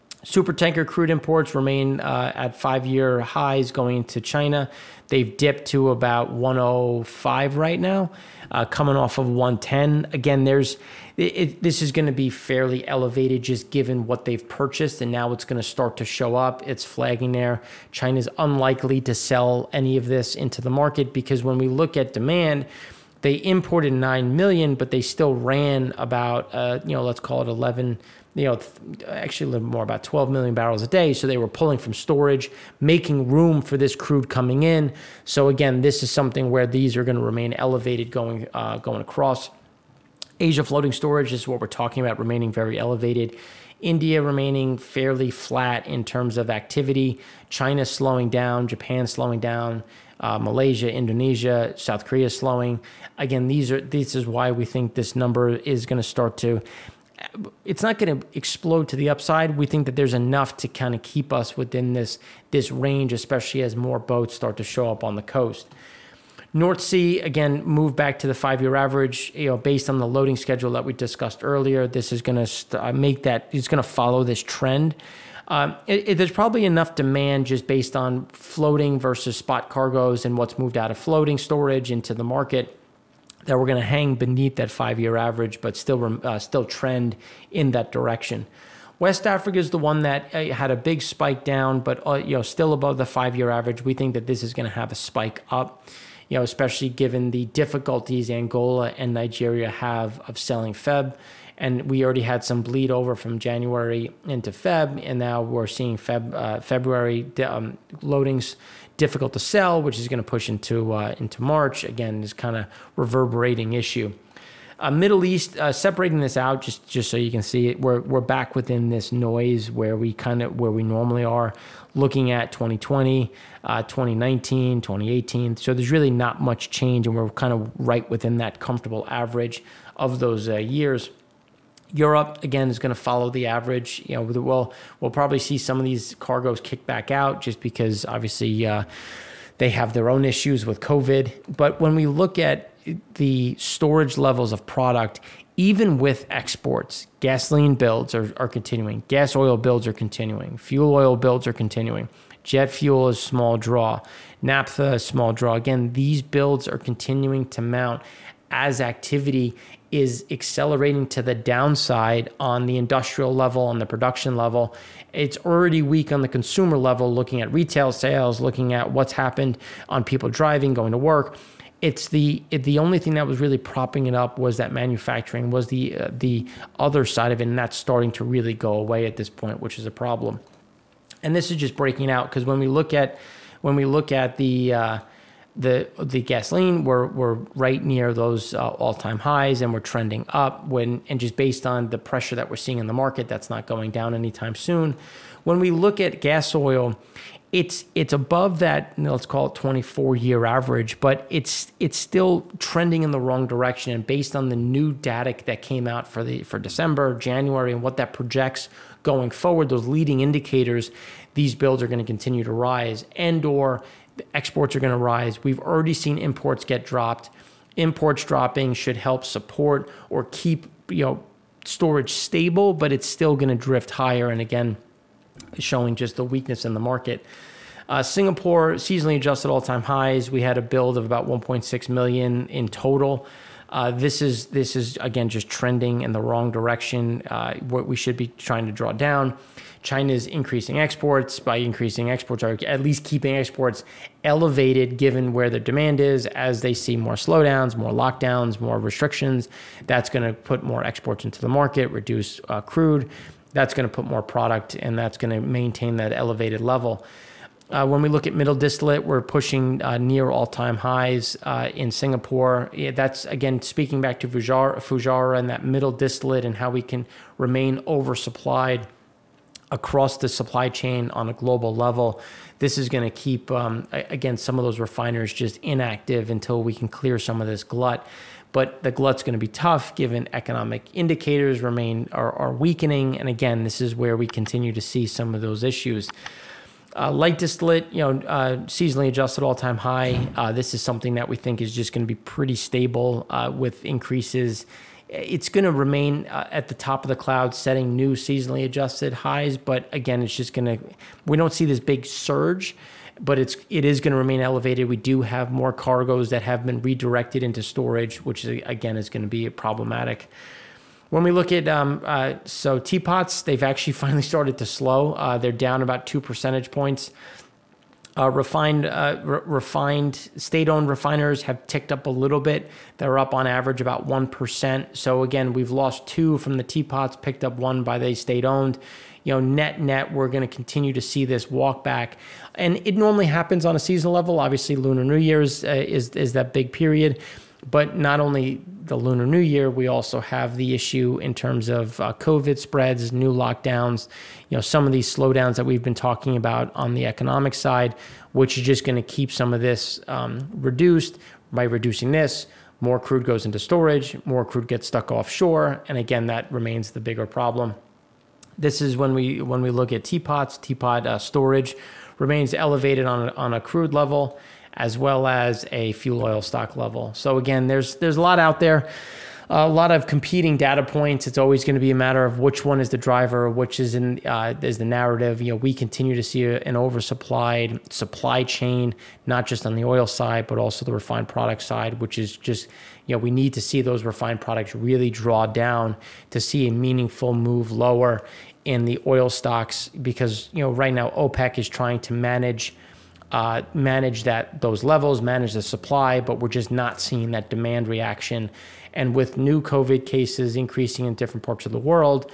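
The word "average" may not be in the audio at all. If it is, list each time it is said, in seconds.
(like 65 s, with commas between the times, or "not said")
68 s, 85 s, 93 s, 129 s, 133 s, 200 s, 323 s.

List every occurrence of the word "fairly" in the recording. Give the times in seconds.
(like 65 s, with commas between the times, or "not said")
12 s, 44 s.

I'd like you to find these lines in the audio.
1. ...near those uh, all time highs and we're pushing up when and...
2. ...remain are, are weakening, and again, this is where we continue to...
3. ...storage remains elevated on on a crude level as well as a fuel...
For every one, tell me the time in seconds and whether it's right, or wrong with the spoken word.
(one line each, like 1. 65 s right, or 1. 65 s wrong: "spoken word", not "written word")
1. 187 s wrong: "trending", not "pushing"
2. 281 s right
3. 361 s right.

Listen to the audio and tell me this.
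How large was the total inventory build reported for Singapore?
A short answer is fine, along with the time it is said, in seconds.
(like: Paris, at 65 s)
1.6 million, at 231 s.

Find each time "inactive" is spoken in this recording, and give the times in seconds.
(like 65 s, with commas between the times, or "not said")
275 s.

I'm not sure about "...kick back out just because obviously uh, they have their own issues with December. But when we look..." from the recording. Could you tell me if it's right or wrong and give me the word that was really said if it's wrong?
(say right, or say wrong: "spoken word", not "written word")
wrong: "COVID", not "December".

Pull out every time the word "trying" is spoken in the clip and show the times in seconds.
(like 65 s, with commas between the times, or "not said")
238 s, 391 s.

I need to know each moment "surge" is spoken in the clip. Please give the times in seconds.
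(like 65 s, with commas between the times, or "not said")
302 s.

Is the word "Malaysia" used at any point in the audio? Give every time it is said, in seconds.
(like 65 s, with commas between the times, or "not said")
50 s.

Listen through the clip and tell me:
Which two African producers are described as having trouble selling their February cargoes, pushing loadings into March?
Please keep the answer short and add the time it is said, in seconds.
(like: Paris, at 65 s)
Angola and Nigeria, at 98 s.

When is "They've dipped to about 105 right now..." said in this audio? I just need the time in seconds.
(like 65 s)
5 s.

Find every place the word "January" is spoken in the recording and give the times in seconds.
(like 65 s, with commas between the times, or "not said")
103 s, 207 s.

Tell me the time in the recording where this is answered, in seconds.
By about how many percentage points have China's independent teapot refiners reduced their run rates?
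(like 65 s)
316 s.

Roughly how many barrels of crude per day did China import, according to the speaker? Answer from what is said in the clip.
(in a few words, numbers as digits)
9 million.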